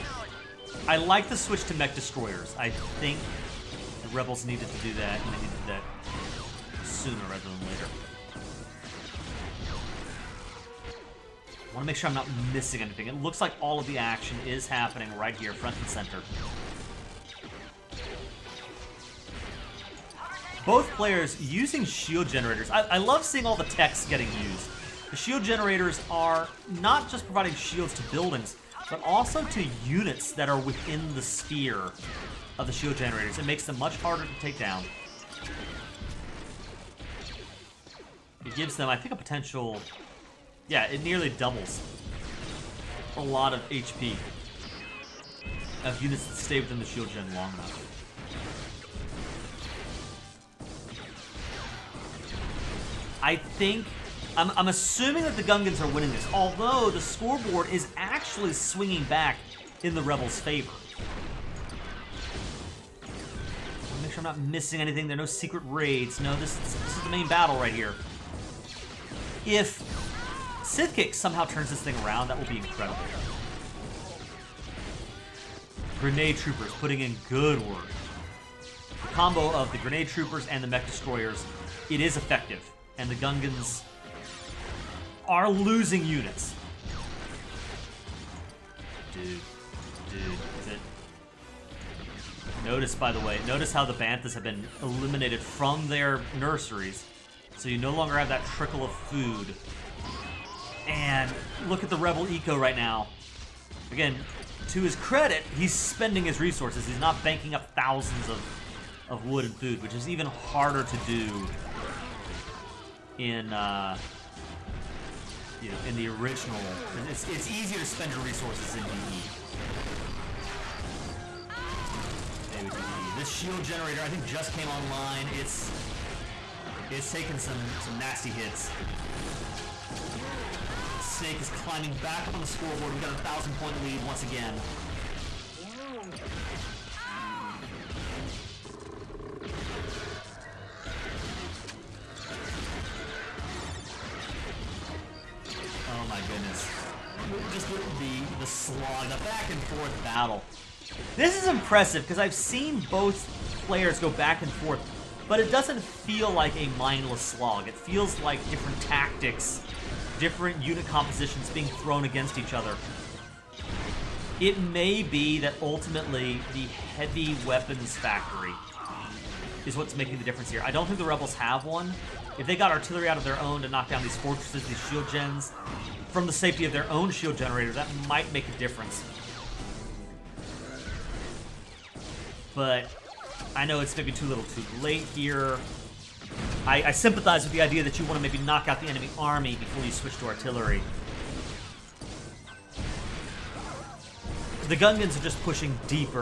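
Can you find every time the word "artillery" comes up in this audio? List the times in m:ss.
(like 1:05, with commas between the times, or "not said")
2:52, 3:10.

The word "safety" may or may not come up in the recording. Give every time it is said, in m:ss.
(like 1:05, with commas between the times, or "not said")
2:56.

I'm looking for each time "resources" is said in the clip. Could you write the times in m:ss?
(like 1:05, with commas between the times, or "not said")
1:46, 1:58.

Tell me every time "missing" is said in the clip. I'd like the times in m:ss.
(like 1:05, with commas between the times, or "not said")
0:12, 1:04.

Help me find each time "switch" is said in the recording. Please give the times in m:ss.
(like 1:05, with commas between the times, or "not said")
0:01, 3:09.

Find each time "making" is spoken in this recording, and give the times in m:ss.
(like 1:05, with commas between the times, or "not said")
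2:49.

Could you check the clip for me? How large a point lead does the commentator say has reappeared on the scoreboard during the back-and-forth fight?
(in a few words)
1000 points.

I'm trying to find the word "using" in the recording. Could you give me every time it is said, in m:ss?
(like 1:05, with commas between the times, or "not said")
0:21.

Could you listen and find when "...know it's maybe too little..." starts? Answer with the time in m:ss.
3:03.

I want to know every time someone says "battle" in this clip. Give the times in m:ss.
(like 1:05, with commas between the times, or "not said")
1:07, 2:30.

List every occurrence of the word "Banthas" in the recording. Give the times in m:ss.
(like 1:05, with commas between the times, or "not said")
1:33.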